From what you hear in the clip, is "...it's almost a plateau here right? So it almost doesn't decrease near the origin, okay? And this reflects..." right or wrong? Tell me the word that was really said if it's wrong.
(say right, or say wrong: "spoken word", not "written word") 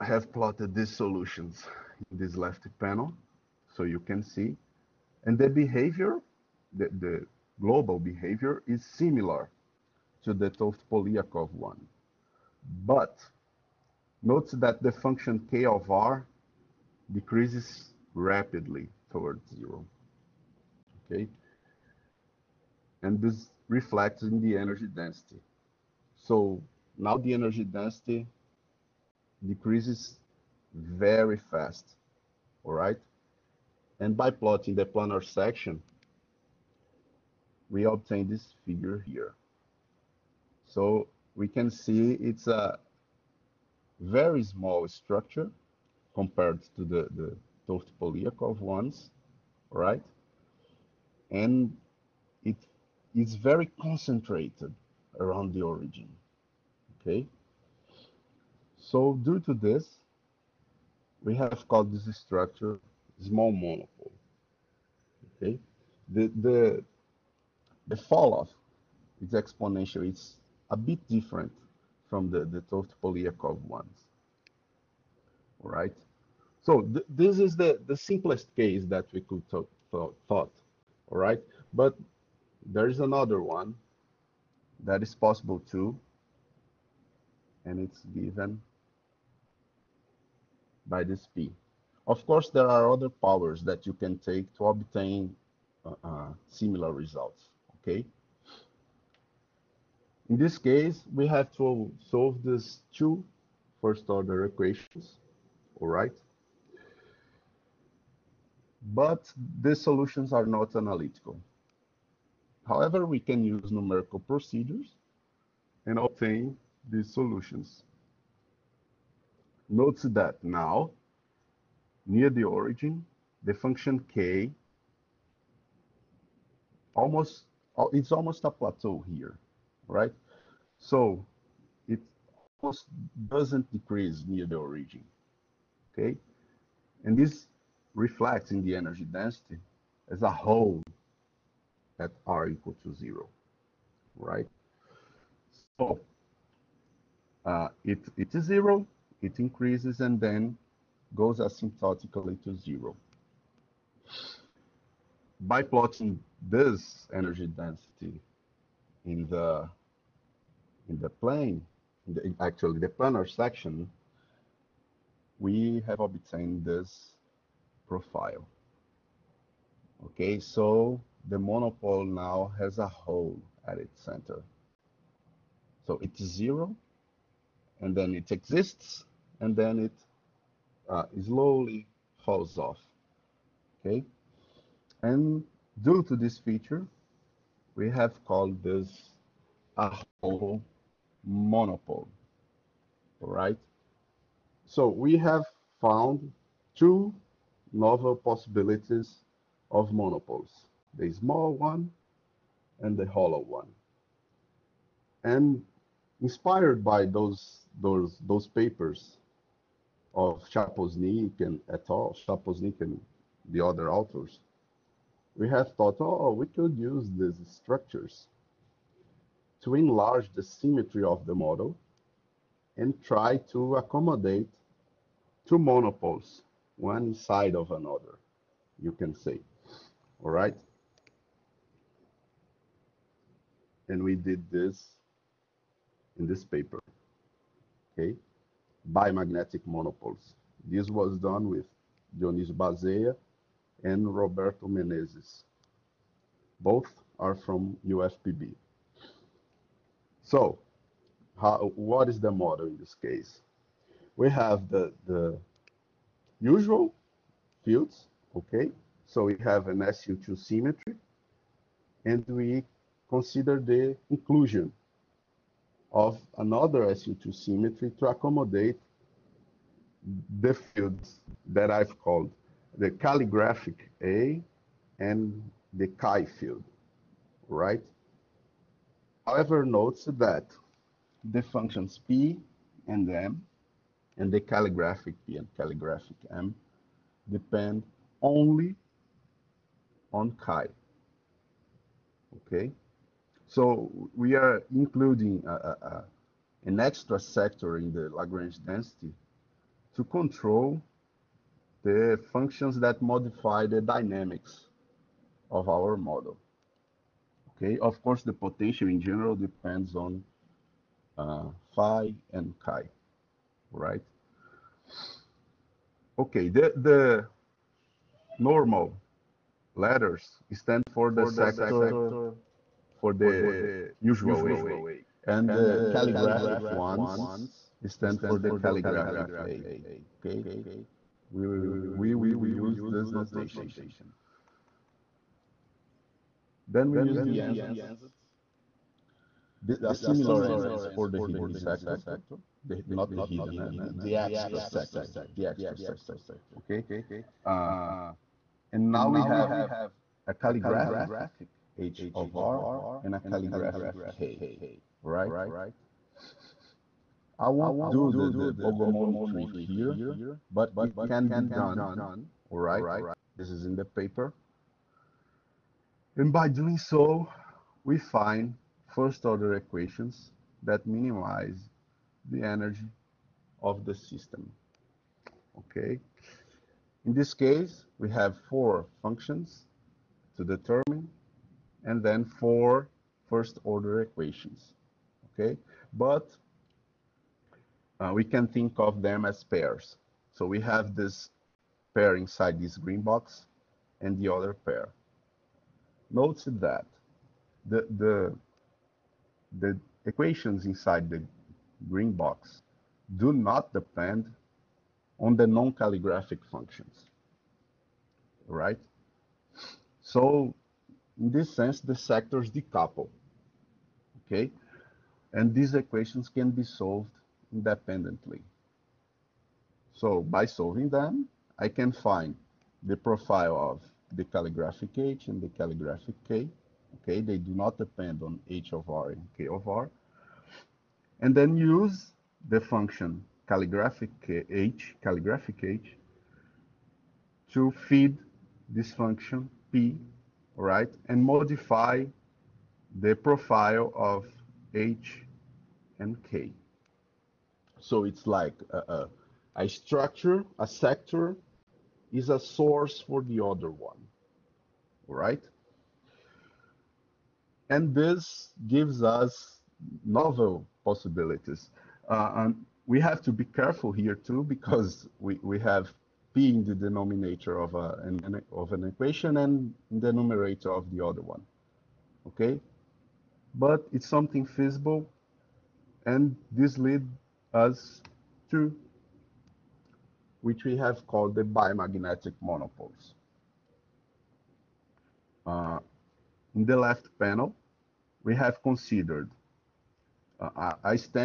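right.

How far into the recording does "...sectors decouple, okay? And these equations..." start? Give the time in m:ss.
6:51.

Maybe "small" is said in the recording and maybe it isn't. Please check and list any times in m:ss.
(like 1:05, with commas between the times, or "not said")
0:44, 1:03, 3:21.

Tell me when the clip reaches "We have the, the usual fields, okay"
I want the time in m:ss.
4:14.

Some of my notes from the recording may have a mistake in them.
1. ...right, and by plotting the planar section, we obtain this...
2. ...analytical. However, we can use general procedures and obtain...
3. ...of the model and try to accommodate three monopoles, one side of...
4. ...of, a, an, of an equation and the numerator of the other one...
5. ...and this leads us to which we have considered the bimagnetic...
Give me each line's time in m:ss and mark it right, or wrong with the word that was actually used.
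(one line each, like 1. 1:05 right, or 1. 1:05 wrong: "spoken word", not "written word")
1. 0:32 right
2. 1:50 wrong: "numerical", not "general"
3. 3:41 wrong: "two", not "three"
4. 7:47 right
5. 7:56 wrong: "called", not "considered".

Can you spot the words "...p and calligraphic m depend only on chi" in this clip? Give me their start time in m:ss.
4:45.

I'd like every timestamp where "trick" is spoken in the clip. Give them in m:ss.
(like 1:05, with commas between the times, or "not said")
5:59.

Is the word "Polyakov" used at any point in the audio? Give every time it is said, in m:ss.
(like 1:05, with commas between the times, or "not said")
0:10, 0:47, 1:13.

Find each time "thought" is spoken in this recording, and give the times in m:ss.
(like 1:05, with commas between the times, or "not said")
1:19, 3:35.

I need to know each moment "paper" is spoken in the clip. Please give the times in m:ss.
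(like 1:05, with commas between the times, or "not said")
3:28, 3:56, 6:03.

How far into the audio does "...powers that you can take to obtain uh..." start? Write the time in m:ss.
1:33.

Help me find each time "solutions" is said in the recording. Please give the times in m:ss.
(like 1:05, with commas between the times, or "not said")
0:00, 1:49, 1:57.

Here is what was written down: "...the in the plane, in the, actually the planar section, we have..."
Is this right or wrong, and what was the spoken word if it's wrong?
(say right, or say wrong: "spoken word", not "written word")
right.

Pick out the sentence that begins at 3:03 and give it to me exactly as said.
Okay, and due to this feature, we have called this a hole monopole, right?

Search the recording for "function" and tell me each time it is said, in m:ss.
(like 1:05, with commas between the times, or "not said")
0:14, 2:03, 4:41, 5:02, 6:19, 6:46, 7:12, 7:18.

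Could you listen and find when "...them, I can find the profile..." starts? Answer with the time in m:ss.
7:00.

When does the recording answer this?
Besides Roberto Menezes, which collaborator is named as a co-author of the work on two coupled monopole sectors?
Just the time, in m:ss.
4:02.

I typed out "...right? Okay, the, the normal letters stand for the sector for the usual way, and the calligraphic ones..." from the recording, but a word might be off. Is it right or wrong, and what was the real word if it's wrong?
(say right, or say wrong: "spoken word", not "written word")
right.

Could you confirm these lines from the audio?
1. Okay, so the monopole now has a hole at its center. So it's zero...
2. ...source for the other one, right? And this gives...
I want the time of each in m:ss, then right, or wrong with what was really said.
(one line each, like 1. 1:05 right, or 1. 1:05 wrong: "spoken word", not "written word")
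1. 2:50 right
2. 7:32 right.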